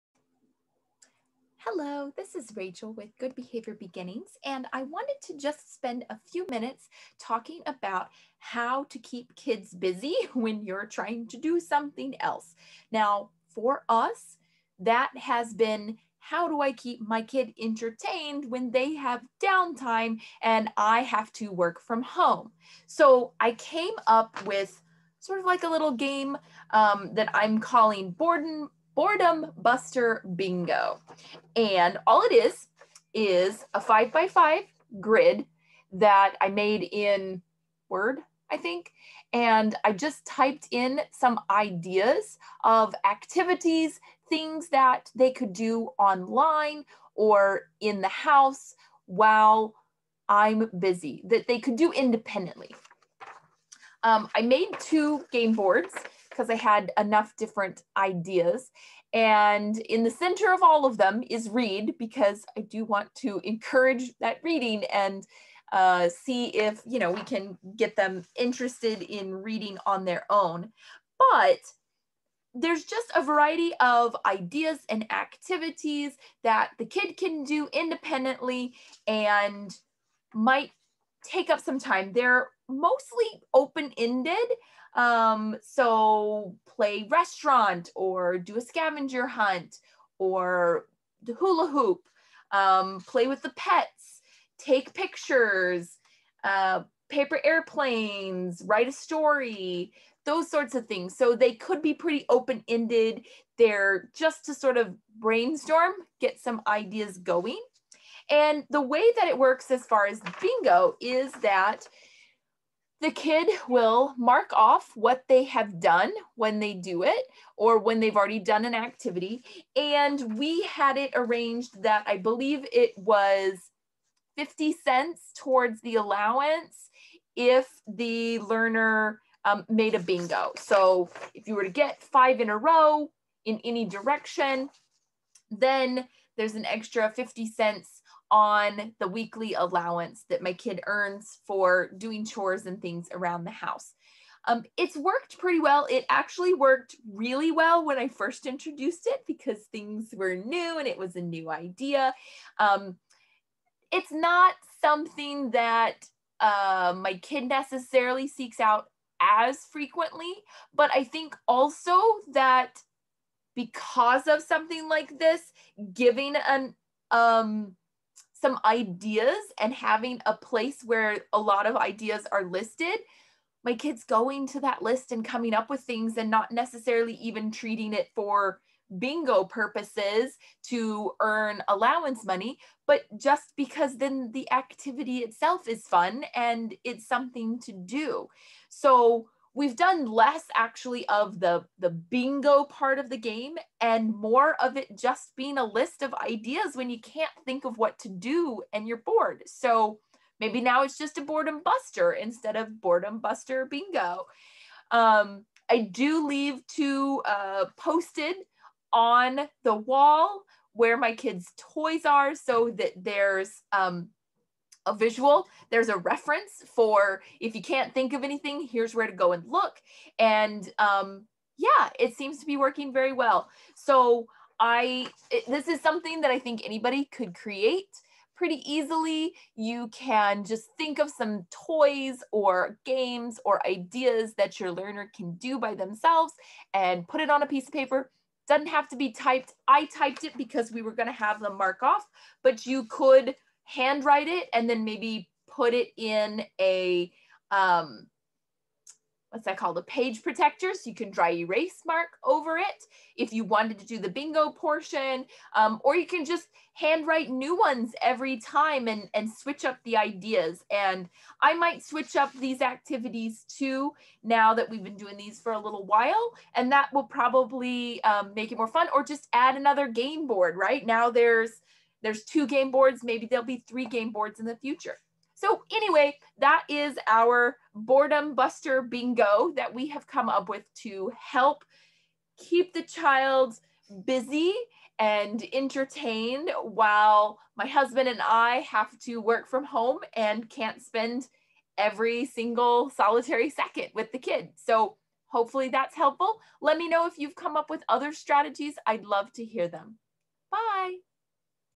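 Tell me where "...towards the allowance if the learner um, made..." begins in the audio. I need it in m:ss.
2:05.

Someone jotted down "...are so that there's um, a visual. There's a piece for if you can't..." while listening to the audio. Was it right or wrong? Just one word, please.
wrong.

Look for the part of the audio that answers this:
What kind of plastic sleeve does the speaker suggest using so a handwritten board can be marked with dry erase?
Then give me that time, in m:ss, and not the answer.
4:09.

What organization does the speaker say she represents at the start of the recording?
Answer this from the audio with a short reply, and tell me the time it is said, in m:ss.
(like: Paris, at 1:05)
Good Behavior Beginnings, at 0:03.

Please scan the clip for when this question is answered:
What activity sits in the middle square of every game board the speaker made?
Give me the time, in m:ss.
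1:01.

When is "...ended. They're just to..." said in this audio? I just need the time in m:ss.
1:42.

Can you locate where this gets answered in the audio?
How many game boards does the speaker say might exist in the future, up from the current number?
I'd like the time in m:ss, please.
4:33.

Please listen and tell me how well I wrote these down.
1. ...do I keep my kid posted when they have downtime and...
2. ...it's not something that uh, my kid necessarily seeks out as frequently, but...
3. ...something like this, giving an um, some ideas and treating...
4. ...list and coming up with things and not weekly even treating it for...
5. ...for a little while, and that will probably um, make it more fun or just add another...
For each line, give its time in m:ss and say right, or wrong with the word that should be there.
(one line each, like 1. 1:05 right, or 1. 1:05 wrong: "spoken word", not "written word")
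1. 0:16 wrong: "entertained", not "posted"
2. 2:33 right
3. 2:44 wrong: "having", not "treating"
4. 2:54 wrong: "necessarily", not "weekly"
5. 4:25 right.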